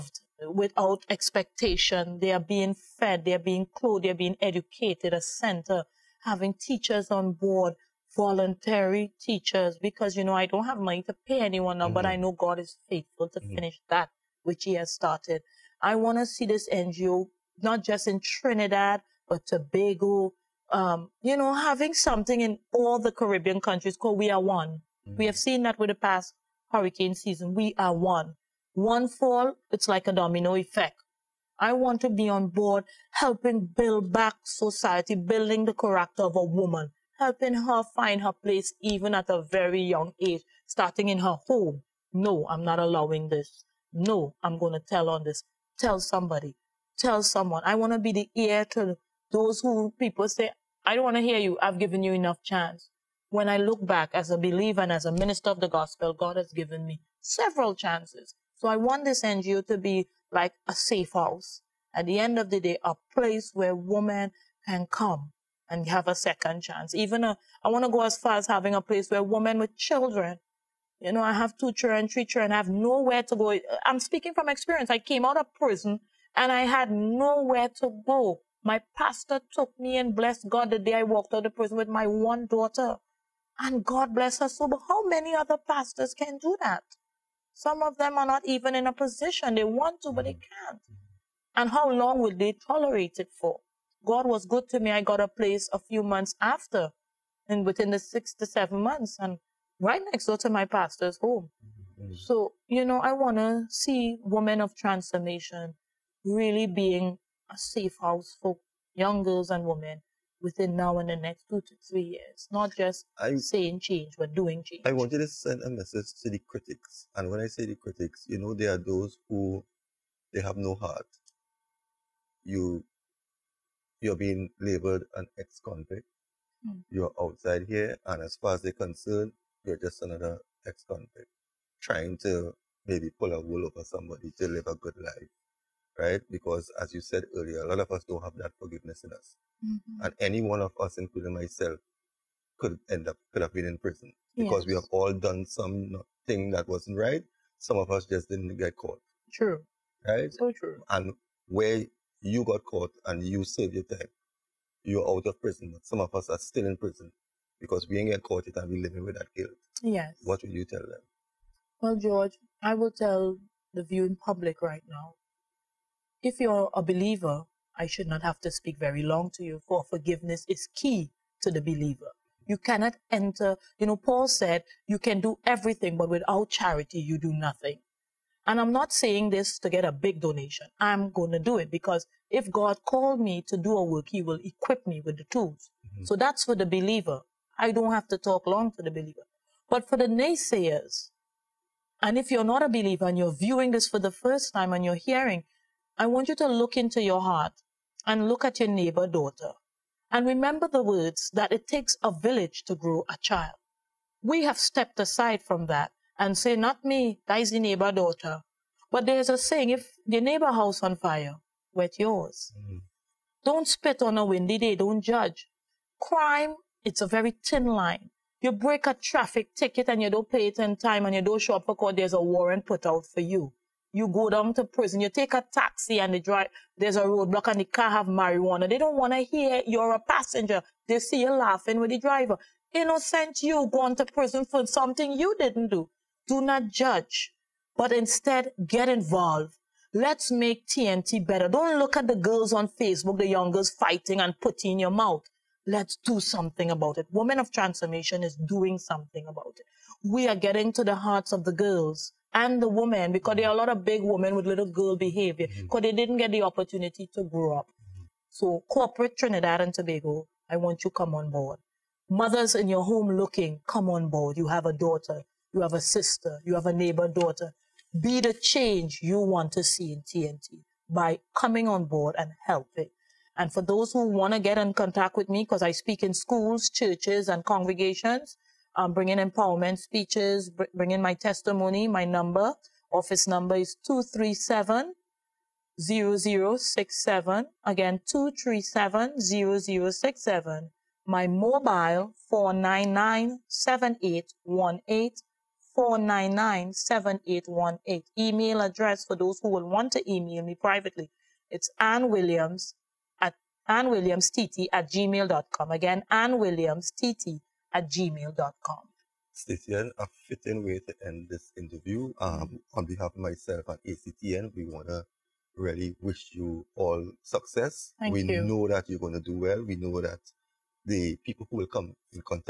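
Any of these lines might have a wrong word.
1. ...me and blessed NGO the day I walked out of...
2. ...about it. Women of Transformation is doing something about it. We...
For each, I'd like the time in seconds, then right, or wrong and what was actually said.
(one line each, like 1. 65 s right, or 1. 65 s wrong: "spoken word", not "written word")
1. 79 s wrong: "God", not "NGO"
2. 246 s right.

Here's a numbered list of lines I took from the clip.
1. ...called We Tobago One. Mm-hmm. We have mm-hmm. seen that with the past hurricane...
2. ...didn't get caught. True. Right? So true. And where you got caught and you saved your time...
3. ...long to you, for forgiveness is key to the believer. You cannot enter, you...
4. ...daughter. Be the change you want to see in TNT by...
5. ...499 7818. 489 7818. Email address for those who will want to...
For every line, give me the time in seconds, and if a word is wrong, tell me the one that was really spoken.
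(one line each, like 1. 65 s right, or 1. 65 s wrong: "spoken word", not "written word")
1. 23 s wrong: "Are", not "Tobago"
2. 148 s right
3. 169 s right
4. 267 s right
5. 292 s wrong: "499", not "489".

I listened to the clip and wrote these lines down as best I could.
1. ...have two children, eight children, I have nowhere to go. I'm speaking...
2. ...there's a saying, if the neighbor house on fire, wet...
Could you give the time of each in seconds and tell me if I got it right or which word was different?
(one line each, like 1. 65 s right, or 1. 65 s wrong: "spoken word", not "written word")
1. 71 s wrong: "three", not "eight"
2. 209 s right.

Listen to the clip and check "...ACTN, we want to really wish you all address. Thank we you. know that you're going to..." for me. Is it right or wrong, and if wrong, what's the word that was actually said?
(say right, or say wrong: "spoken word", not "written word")
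wrong: "success", not "address".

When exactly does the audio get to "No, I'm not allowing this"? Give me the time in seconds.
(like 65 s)
42 s.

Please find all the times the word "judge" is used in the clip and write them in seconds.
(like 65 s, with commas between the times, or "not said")
215 s, 236 s.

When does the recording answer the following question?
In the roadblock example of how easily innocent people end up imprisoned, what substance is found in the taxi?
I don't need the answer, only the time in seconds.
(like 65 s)
228 s.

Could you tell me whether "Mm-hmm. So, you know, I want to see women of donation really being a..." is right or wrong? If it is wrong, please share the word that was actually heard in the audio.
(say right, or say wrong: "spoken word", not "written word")
wrong: "transformation", not "donation".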